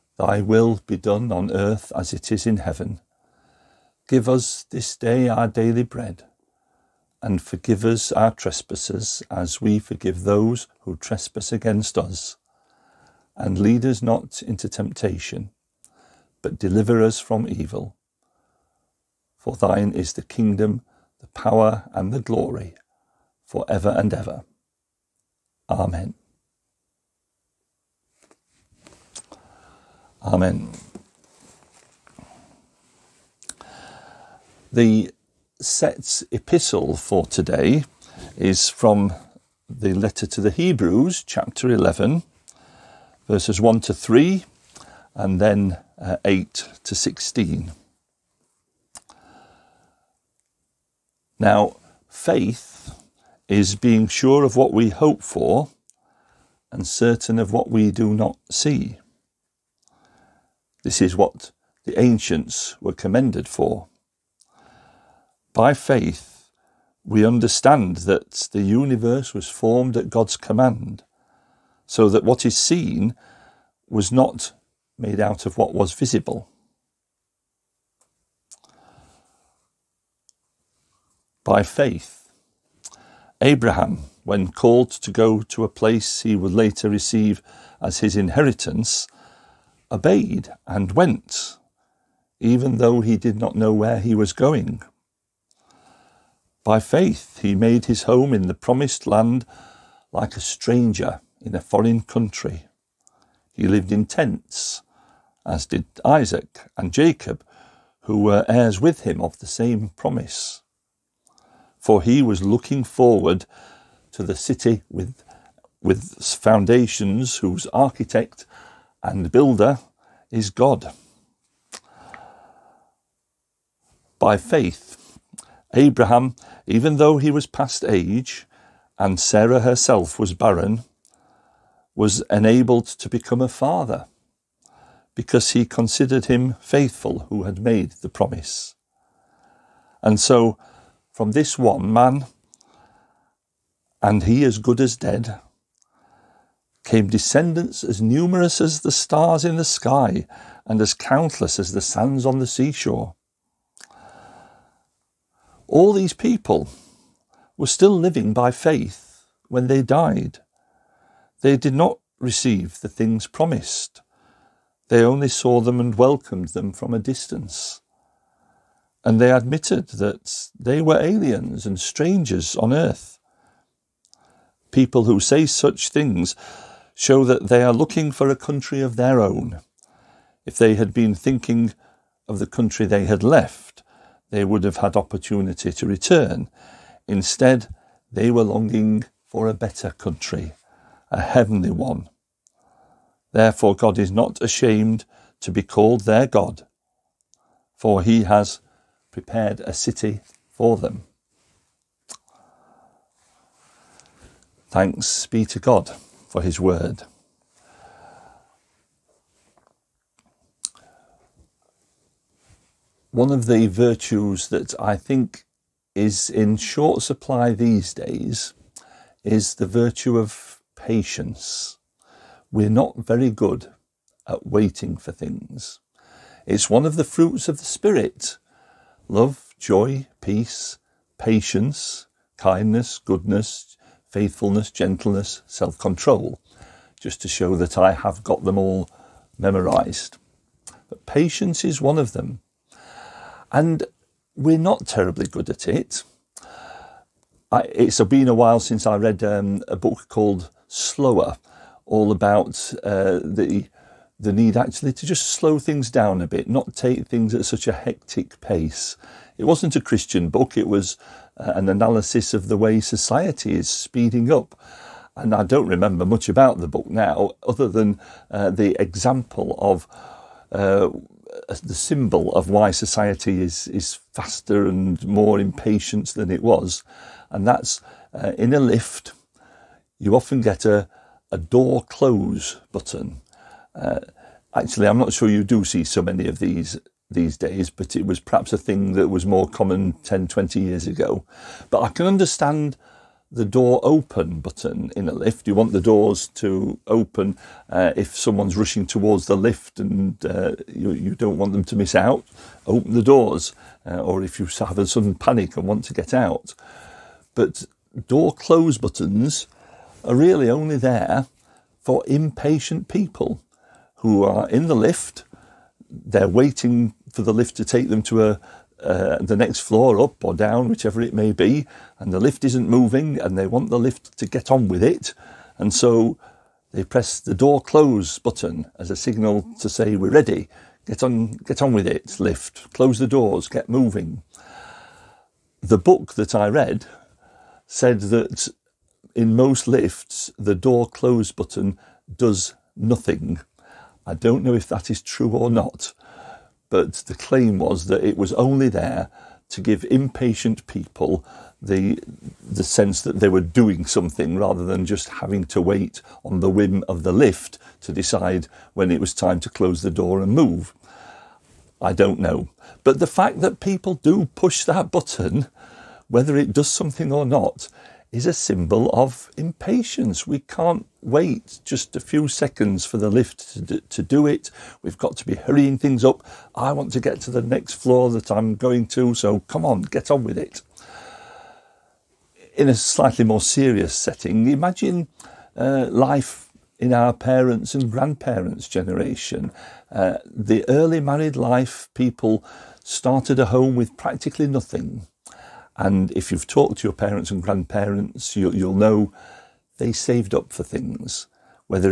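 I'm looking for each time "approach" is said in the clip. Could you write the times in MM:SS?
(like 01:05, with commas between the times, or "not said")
not said.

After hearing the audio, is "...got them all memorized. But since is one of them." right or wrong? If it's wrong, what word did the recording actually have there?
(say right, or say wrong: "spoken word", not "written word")
wrong: "patience", not "since".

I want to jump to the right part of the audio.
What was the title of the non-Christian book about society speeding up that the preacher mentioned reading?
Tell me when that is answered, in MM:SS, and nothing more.
04:10.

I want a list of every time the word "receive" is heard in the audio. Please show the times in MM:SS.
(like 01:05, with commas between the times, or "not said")
01:26, 02:42.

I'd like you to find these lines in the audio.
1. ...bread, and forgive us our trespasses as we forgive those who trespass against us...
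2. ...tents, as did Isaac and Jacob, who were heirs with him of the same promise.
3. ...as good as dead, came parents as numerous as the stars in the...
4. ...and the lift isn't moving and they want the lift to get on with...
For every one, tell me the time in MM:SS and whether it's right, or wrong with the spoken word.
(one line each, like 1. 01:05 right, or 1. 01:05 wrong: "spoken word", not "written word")
1. 00:05 right
2. 01:44 right
3. 02:24 wrong: "descendants", not "parents"
4. 05:21 right.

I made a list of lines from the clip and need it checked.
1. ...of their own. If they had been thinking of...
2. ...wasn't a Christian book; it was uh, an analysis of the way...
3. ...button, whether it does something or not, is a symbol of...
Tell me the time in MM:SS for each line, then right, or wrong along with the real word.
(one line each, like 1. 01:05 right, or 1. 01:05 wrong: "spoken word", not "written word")
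1. 02:58 right
2. 04:19 right
3. 06:04 right.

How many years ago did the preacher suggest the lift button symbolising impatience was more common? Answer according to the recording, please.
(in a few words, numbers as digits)
10, 20 years.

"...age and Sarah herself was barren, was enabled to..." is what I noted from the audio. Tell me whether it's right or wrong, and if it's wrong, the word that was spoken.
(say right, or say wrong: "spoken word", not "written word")
right.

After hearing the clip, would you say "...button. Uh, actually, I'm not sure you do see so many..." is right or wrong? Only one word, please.
right.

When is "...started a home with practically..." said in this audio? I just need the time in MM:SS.
06:32.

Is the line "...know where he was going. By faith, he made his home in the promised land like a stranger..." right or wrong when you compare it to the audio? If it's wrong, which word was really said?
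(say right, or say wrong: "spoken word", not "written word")
right.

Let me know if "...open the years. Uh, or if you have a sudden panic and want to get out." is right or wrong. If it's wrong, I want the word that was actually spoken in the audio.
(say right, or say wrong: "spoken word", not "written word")
wrong: "doors", not "years".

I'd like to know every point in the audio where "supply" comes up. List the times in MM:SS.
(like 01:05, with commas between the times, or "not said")
03:37.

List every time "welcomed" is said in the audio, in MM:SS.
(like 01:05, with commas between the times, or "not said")
02:45.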